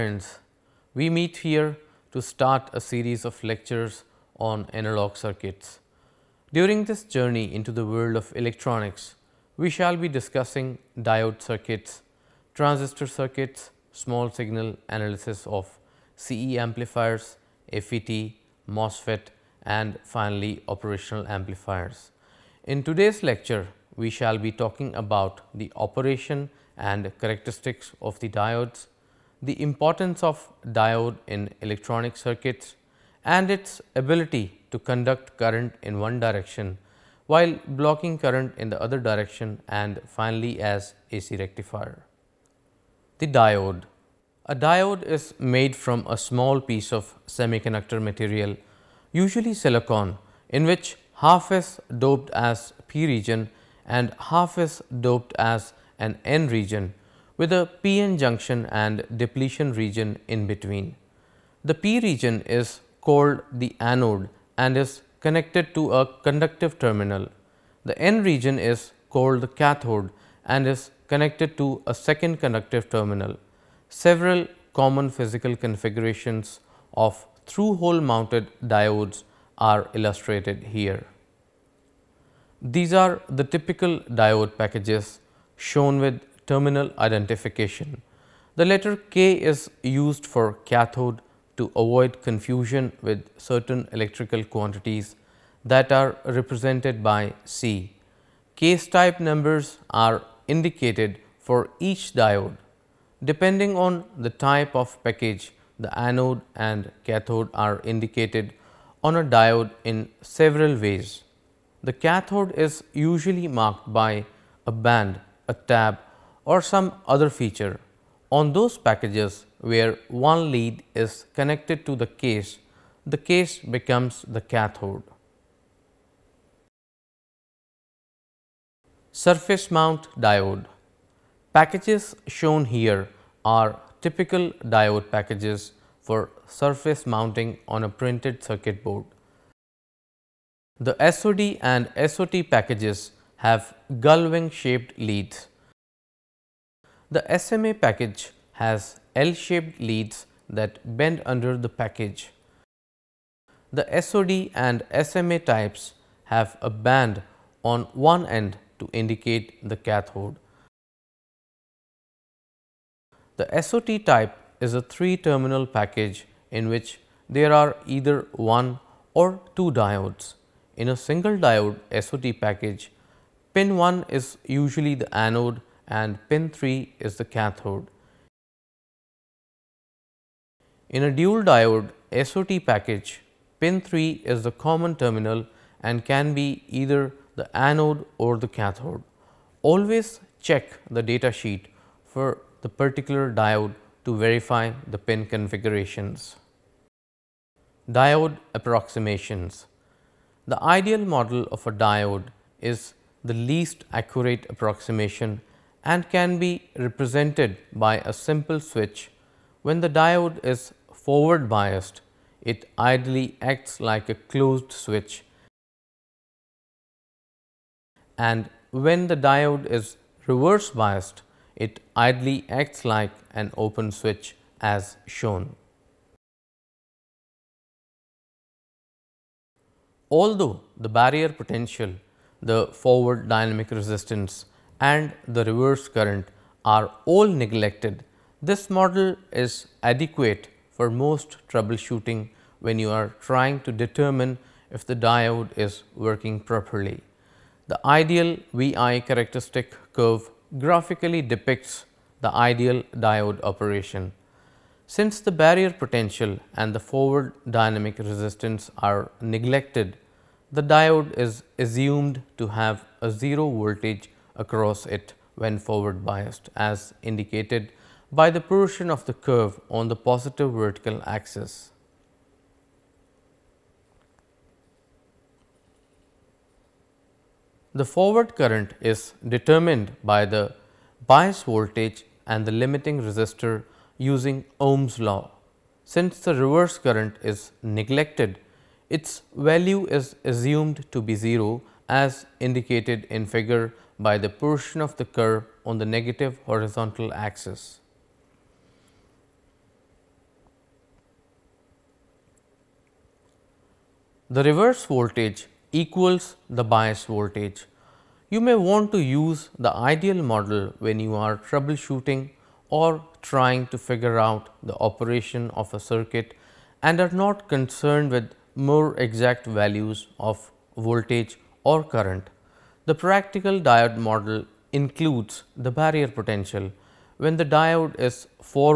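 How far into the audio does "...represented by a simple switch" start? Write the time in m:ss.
3:26.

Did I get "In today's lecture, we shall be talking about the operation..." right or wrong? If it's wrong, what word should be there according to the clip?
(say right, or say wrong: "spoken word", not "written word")
right.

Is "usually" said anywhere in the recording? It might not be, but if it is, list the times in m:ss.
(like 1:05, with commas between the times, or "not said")
0:49, 1:52, 2:54.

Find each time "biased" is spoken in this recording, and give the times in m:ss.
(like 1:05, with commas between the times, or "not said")
3:31, 3:40, 4:26.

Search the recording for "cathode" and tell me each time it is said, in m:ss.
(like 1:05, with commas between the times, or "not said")
1:09, 1:30, 1:47, 1:51, 2:04, 2:39, 2:57, 3:08.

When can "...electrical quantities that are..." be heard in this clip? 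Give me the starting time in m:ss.
1:33.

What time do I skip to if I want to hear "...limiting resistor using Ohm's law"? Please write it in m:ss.
4:42.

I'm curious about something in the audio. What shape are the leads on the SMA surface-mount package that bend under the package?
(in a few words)
L-shaped.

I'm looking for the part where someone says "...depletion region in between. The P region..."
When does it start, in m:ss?
0:59.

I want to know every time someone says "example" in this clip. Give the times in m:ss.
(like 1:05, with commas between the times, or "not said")
not said.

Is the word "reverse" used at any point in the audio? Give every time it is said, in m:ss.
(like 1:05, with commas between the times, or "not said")
3:40, 3:55, 4:46, 5:04.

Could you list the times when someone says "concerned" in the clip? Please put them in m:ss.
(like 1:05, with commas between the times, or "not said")
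5:17.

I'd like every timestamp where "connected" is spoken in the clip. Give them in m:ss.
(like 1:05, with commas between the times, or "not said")
1:05, 1:11, 2:01.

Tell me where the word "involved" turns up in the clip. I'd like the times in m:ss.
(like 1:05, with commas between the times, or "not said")
not said.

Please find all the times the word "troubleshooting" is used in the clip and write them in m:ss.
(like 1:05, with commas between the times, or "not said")
4:01, 5:11.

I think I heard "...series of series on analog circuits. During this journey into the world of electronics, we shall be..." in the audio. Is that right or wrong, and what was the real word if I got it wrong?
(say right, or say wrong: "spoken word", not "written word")
wrong: "lectures", not "series".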